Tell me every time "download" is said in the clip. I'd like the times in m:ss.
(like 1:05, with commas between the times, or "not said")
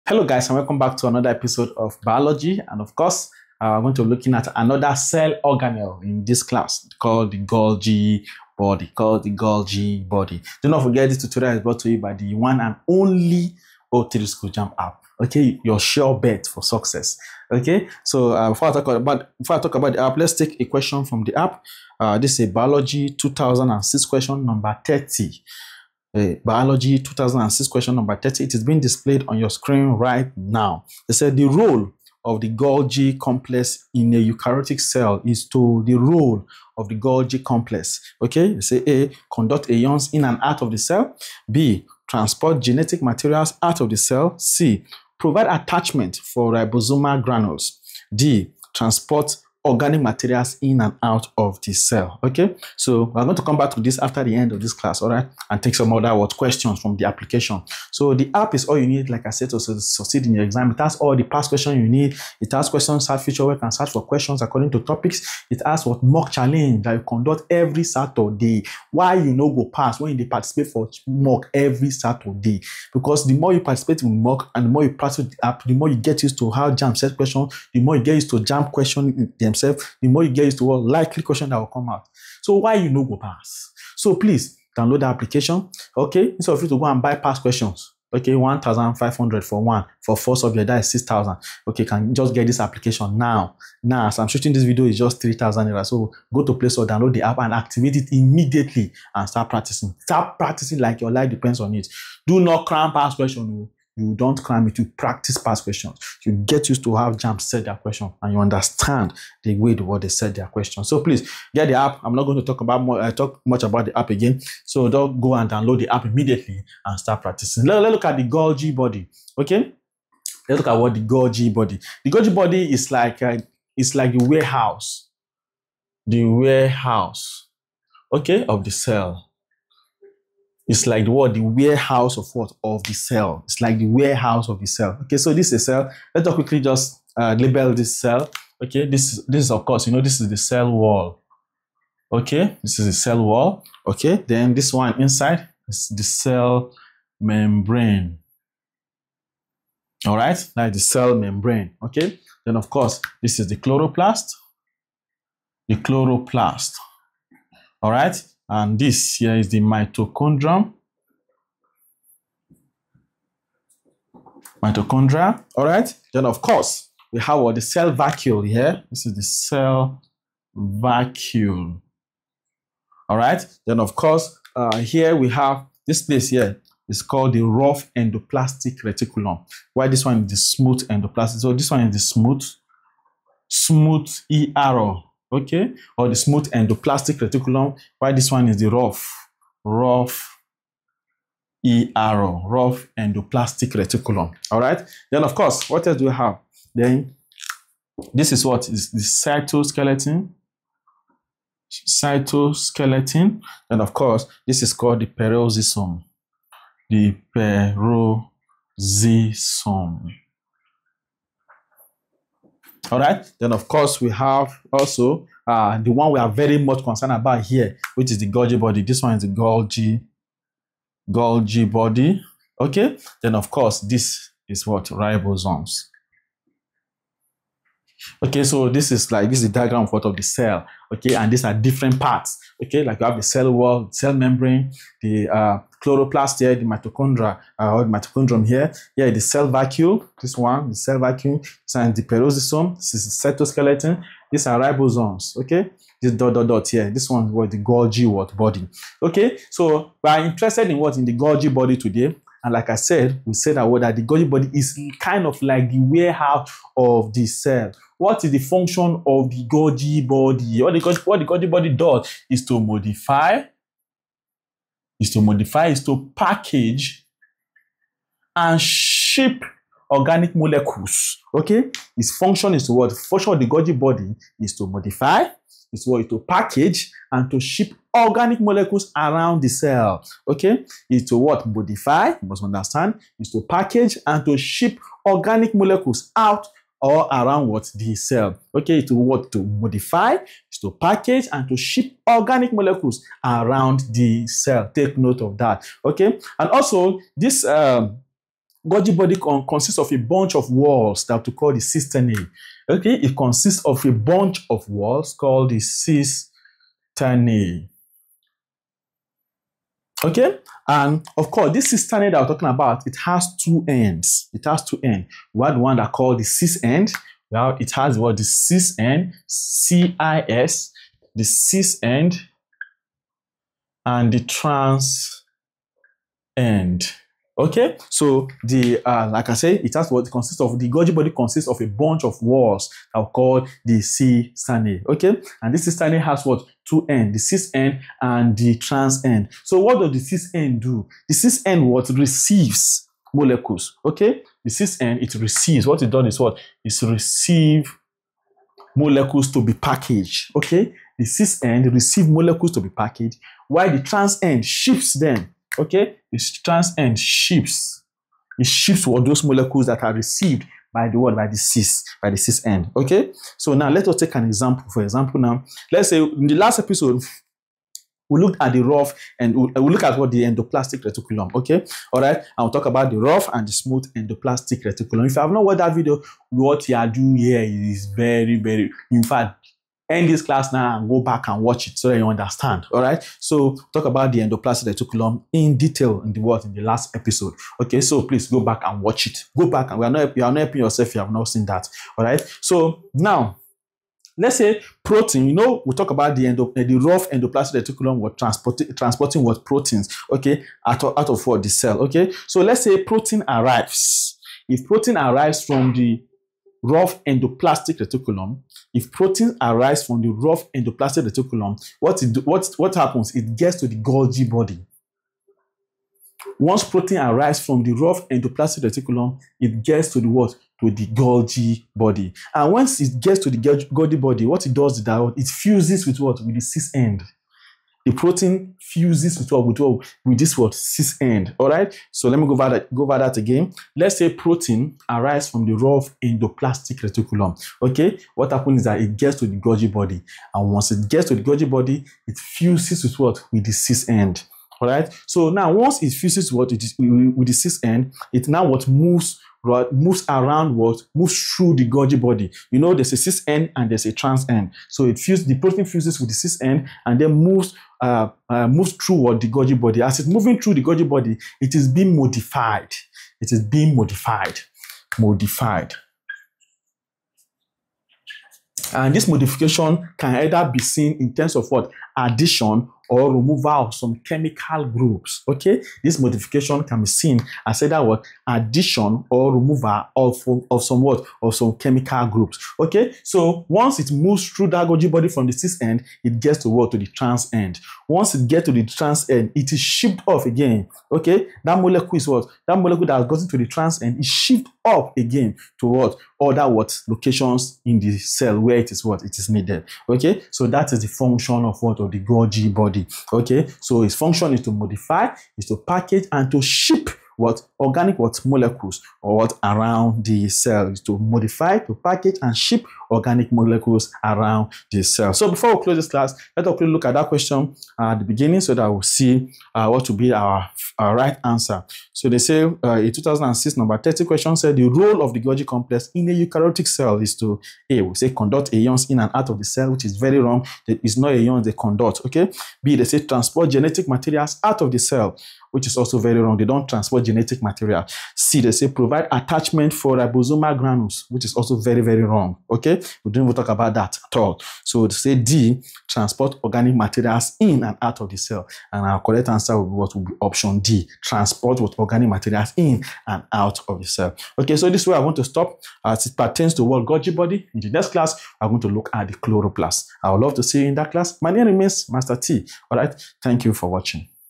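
1:24, 1:36, 1:55.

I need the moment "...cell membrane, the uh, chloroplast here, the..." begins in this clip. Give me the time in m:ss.
3:53.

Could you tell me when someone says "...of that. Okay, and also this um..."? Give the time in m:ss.
4:55.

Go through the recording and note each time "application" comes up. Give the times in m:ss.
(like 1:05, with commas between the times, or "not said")
0:57, 1:25, 1:32.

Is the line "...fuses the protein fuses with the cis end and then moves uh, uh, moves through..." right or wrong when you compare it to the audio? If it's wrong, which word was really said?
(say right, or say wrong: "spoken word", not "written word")
right.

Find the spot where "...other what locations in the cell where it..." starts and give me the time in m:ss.
8:16.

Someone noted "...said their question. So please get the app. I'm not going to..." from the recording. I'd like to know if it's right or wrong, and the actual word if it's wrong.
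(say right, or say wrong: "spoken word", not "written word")
right.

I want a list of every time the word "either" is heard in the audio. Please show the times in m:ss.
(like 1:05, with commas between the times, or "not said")
7:50, 7:57.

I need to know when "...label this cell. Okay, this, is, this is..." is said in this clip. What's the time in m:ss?
2:17.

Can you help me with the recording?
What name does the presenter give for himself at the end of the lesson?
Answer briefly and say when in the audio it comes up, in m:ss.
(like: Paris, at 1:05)
Master T, at 9:21.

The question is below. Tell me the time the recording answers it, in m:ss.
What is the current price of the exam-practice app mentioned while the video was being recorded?
1:35.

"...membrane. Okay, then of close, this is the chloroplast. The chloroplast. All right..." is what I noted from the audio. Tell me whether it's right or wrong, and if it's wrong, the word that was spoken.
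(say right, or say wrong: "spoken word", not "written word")
wrong: "course", not "close".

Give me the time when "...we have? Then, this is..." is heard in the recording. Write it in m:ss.
3:16.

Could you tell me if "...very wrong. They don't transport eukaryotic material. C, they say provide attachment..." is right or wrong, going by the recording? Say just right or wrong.
wrong.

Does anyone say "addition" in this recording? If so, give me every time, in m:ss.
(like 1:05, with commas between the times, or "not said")
7:51, 7:58.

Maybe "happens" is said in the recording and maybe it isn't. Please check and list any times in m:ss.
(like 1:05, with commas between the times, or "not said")
6:52, 7:18.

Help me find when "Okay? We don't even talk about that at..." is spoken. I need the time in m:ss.
9:02.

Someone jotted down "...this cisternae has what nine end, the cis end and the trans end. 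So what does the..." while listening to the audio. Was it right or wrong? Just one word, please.
wrong.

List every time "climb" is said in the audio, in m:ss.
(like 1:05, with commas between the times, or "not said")
1:44.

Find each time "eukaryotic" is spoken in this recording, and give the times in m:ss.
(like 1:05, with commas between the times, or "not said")
0:34, 8:46.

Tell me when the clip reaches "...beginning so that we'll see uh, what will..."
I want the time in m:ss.
8:38.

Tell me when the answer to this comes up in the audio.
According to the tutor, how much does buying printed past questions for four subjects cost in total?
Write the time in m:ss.
1:30.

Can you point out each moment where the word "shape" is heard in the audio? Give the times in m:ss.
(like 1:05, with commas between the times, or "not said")
4:28.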